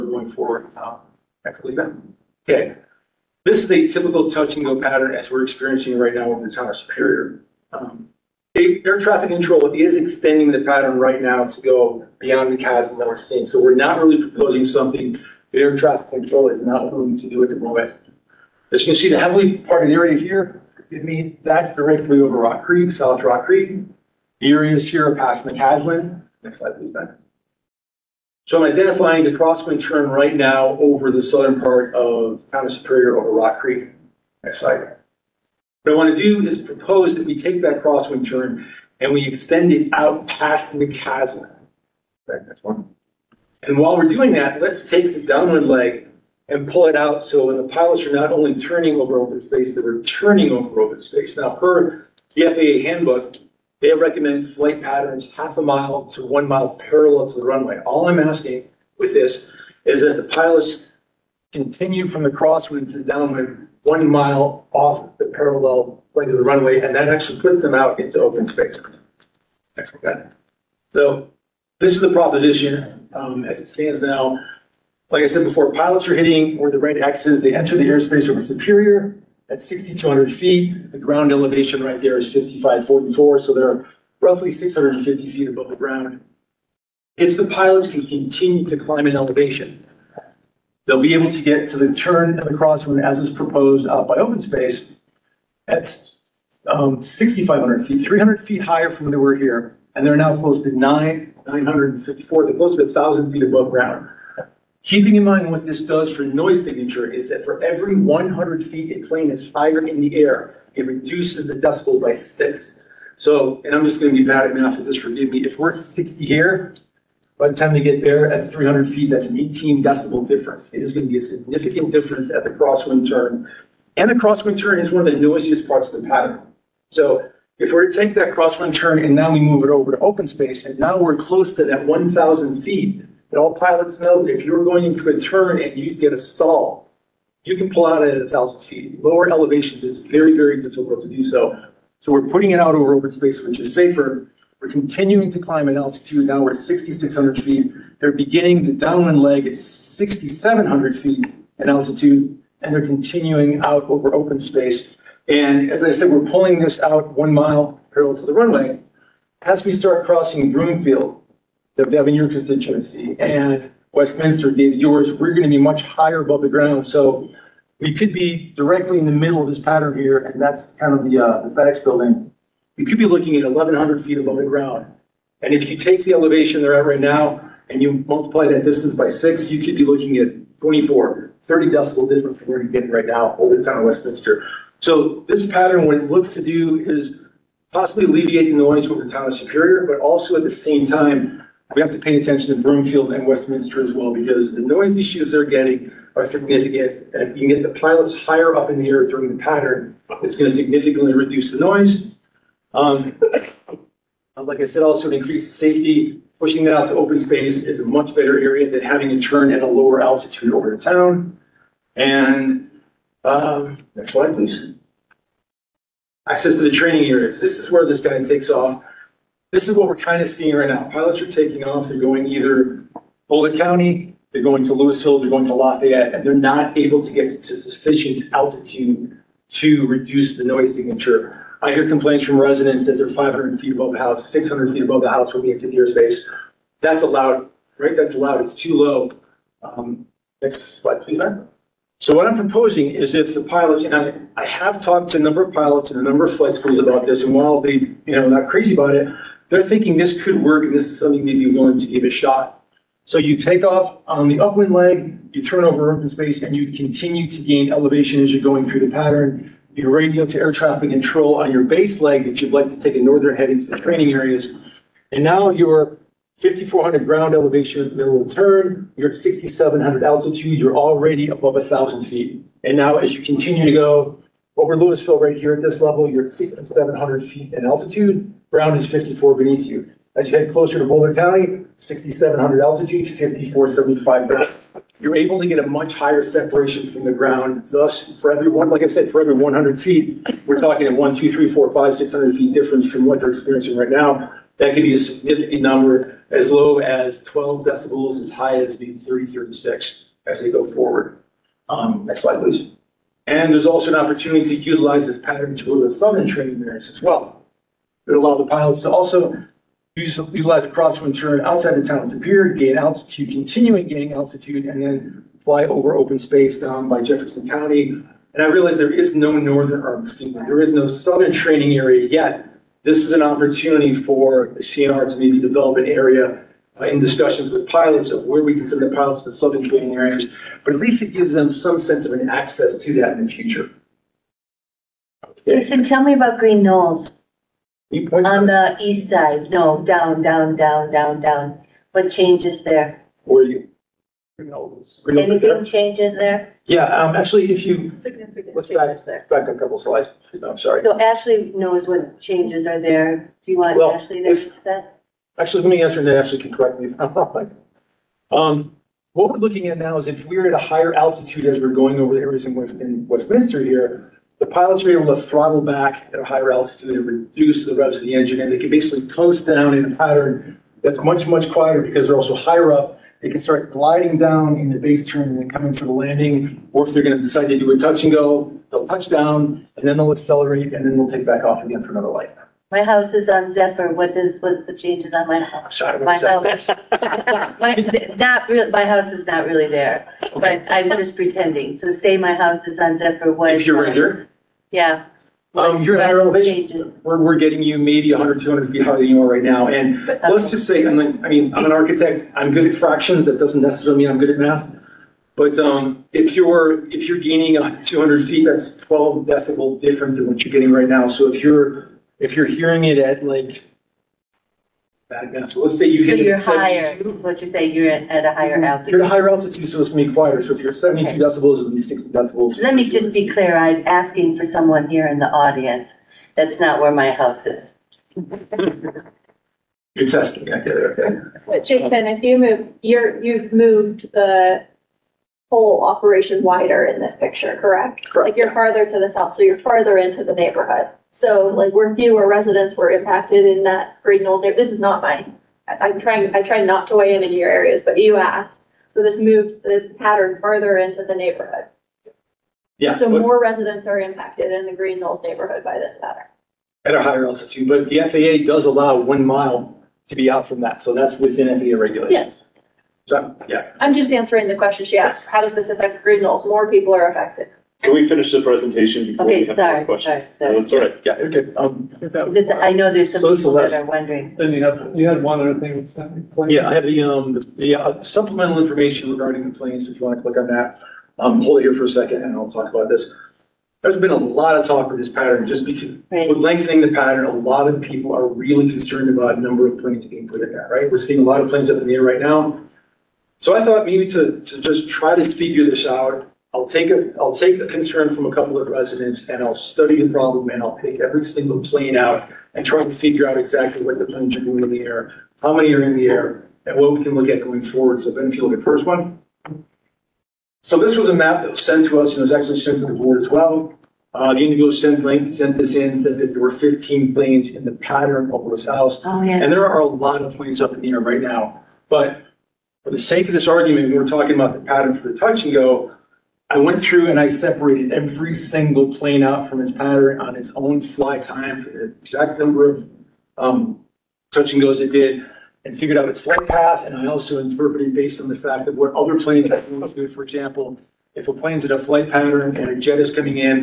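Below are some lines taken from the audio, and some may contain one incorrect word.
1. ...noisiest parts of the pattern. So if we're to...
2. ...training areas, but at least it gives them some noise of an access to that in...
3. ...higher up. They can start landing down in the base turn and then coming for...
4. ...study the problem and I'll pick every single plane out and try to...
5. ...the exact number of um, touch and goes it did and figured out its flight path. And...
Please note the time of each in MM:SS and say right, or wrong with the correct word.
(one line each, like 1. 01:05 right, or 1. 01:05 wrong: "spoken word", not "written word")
1. 02:05 right
2. 05:29 wrong: "sense", not "noise"
3. 06:12 wrong: "gliding", not "landing"
4. 08:19 right
5. 08:51 right.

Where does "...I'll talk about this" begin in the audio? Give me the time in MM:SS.
08:02.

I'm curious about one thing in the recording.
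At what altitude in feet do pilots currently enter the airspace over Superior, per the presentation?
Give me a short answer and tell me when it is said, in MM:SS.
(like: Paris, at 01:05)
6,200 feet, at 01:19.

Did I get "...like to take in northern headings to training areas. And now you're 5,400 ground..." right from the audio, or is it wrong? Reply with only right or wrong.
right.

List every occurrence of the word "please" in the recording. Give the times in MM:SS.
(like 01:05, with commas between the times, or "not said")
00:26, 03:34, 04:01, 05:02.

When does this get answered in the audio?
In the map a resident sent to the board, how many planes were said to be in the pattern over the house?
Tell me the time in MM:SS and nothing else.
08:36.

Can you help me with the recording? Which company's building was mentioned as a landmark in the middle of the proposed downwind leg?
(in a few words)
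FedEx.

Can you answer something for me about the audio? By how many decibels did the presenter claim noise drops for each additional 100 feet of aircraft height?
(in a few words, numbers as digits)
6.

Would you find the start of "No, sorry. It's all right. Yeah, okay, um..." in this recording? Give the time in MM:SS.
07:50.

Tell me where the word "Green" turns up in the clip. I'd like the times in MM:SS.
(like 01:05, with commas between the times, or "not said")
05:36, 07:24, 07:34, 07:46.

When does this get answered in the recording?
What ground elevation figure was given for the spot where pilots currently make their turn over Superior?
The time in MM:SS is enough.
01:22.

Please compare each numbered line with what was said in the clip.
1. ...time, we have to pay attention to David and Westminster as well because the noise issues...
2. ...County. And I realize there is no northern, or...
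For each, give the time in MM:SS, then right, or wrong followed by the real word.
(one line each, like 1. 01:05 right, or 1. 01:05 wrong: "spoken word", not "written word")
1. 03:10 wrong: "Broomfield", not "David"
2. 05:17 right.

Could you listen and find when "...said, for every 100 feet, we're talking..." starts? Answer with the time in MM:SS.
04:48.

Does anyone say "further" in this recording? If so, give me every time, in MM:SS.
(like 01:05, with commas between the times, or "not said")
07:30.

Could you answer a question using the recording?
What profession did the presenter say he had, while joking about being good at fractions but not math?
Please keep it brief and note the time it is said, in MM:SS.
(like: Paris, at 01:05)
architect, at 06:41.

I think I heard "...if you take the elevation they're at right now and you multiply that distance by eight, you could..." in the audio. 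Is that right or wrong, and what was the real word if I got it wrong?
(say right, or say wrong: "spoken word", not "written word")
wrong: "six", not "eight".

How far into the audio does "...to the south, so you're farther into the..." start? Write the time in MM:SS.
07:18.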